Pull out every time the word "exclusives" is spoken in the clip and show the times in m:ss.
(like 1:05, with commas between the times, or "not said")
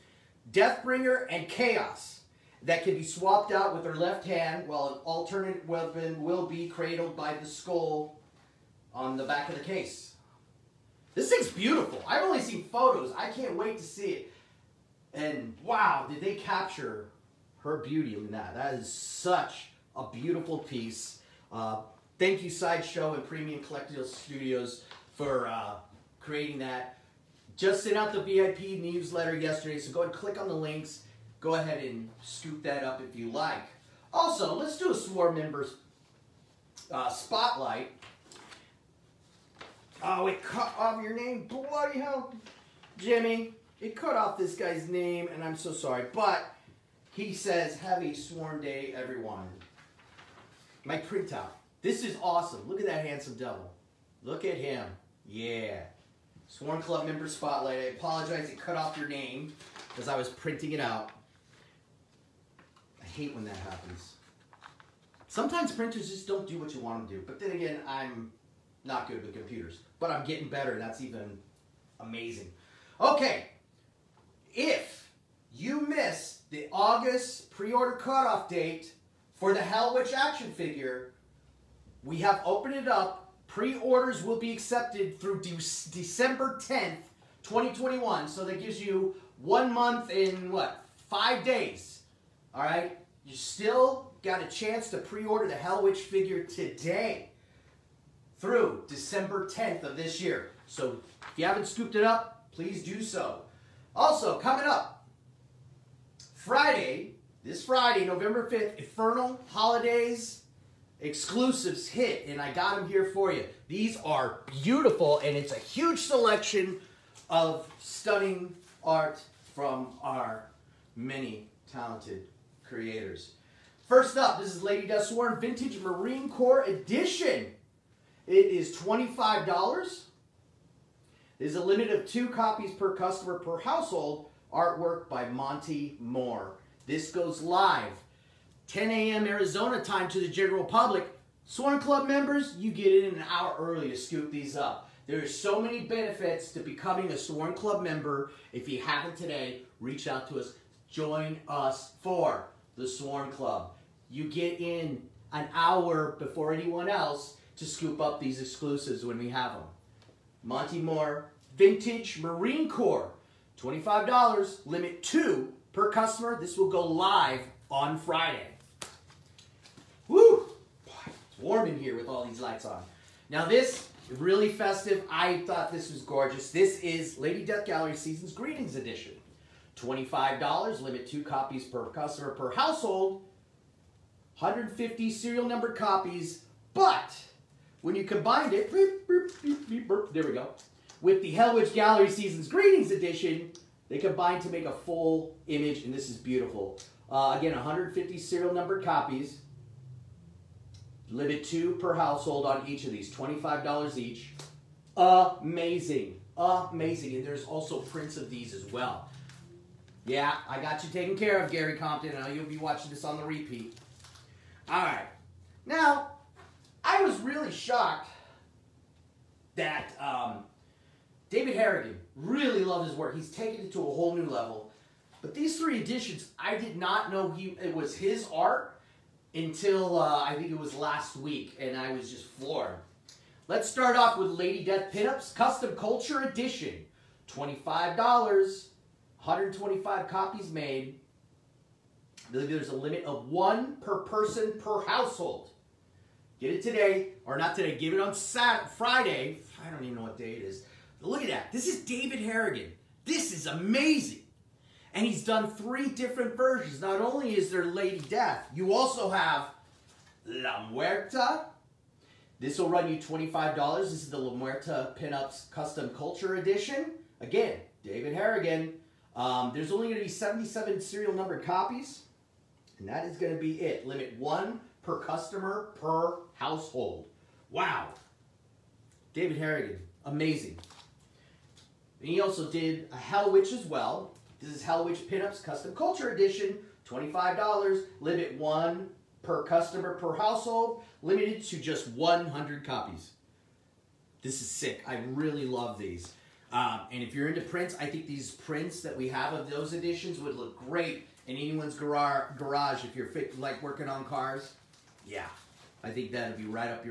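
1:51, 2:38.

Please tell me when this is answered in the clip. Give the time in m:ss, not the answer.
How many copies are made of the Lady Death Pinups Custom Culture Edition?
3:57.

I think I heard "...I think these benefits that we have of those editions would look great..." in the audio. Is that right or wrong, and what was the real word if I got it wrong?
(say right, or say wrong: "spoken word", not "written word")
wrong: "prints", not "benefits".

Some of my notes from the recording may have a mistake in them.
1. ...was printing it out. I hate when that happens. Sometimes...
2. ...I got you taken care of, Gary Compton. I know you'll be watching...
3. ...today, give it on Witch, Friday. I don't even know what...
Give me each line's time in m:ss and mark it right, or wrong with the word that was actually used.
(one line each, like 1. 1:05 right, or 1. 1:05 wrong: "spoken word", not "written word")
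1. 1:00 right
2. 3:30 right
3. 4:07 wrong: "Saturday", not "Witch".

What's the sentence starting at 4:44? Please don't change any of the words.
This is Hell Witch Pinups Custom Culture Edition, $25, limit one per customer per household, limited to just 100 copies.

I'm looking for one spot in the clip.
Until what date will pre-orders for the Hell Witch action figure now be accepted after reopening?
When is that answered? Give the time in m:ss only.
1:25.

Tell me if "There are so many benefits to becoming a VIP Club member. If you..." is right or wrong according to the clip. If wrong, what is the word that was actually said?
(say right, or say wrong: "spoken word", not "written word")
wrong: "Sworn", not "VIP".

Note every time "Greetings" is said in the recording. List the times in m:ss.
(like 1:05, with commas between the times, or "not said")
2:58, 3:12.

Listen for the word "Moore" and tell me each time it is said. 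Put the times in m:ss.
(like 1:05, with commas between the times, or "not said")
2:15, 2:40.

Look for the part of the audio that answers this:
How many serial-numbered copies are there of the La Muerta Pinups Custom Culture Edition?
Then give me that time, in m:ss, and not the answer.
4:30.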